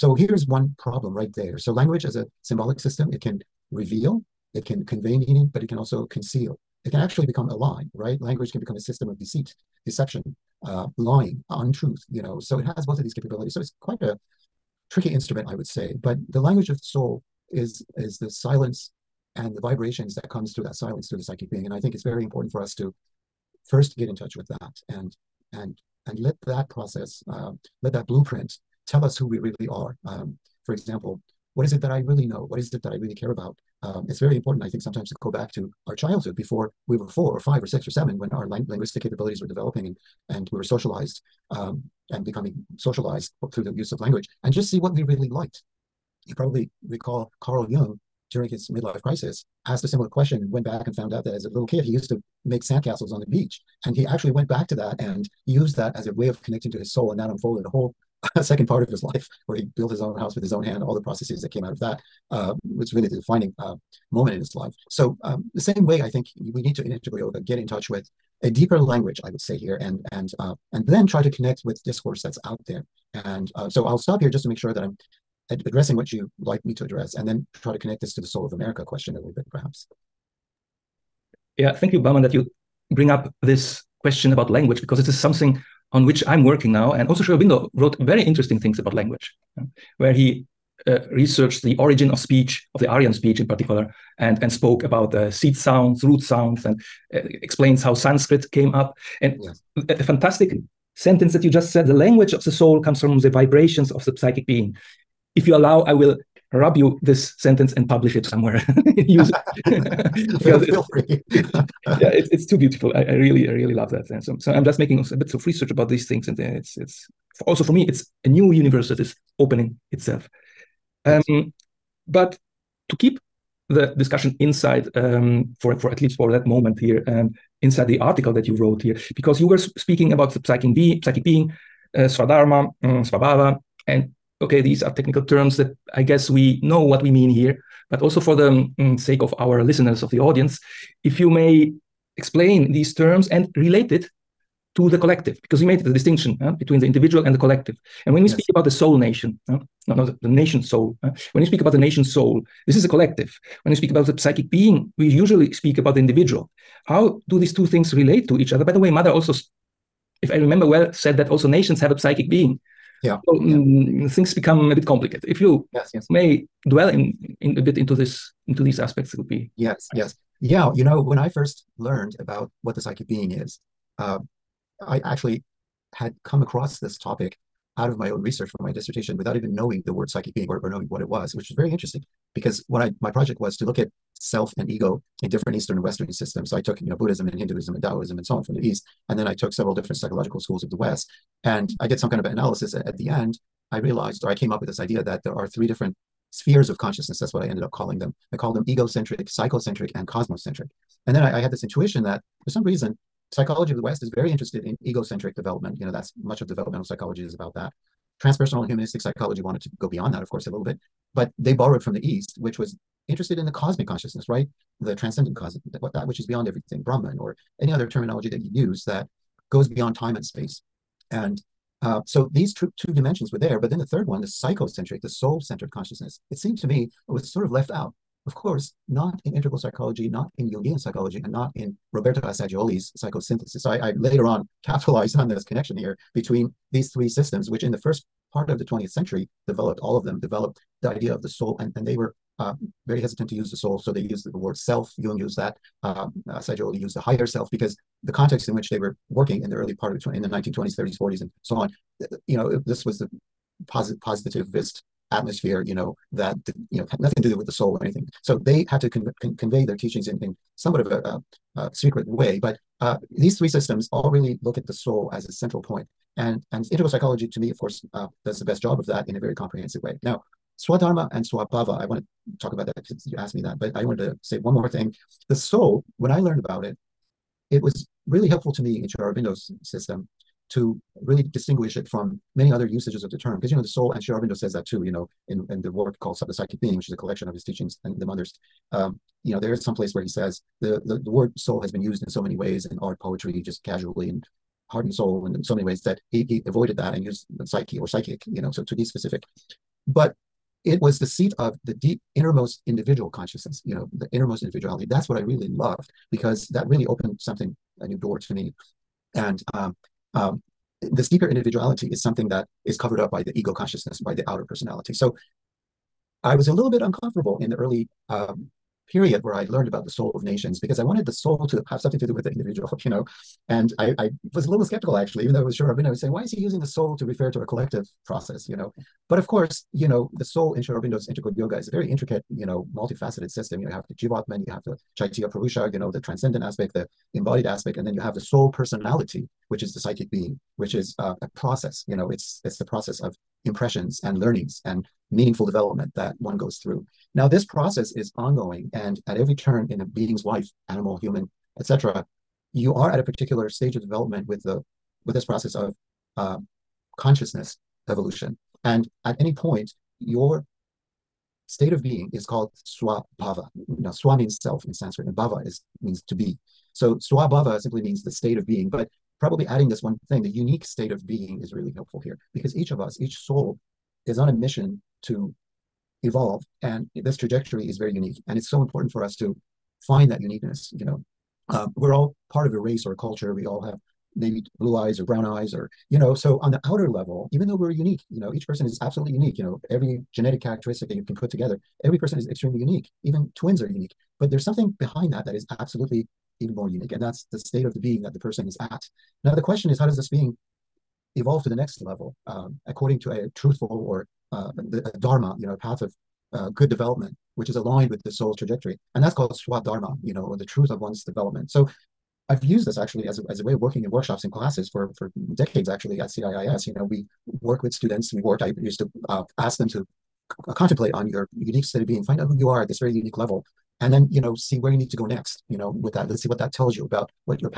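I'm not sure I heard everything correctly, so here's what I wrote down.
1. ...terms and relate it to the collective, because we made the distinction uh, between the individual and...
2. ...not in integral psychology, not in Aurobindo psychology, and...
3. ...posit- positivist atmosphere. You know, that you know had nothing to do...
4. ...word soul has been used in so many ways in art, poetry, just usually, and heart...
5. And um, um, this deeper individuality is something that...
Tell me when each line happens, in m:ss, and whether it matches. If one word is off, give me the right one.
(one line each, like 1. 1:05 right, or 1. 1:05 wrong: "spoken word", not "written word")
1. 2:22 right
2. 3:48 wrong: "Jungian", not "Aurobindo"
3. 4:13 right
4. 4:51 wrong: "casually", not "usually"
5. 5:09 right.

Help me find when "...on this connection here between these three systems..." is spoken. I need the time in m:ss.
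3:55.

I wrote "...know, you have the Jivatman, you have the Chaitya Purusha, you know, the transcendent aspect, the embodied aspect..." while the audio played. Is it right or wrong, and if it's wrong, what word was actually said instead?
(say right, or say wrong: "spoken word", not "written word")
right.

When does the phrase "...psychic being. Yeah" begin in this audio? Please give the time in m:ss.
2:41.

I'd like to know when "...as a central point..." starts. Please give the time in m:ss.
4:25.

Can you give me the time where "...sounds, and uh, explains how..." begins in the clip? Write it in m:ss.
1:36.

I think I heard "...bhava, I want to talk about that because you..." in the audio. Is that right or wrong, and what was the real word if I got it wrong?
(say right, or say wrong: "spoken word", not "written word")
wrong: "swabhava", not "bhava".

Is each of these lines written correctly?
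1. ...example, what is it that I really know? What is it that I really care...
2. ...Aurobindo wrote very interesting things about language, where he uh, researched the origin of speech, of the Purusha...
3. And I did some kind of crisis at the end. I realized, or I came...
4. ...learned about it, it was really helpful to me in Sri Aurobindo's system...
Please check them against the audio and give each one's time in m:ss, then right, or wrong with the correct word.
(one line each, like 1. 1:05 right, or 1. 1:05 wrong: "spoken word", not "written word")
1. 0:30 right
2. 1:27 wrong: "Aryan", not "Purusha"
3. 3:11 wrong: "analysis", not "crisis"
4. 4:36 right.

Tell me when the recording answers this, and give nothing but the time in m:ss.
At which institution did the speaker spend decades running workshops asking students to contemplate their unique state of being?
6:56.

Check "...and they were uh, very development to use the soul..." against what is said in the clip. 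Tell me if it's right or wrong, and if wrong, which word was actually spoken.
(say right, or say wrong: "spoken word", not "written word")
wrong: "hesitant", not "development".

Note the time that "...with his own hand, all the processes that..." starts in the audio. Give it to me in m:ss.
1:00.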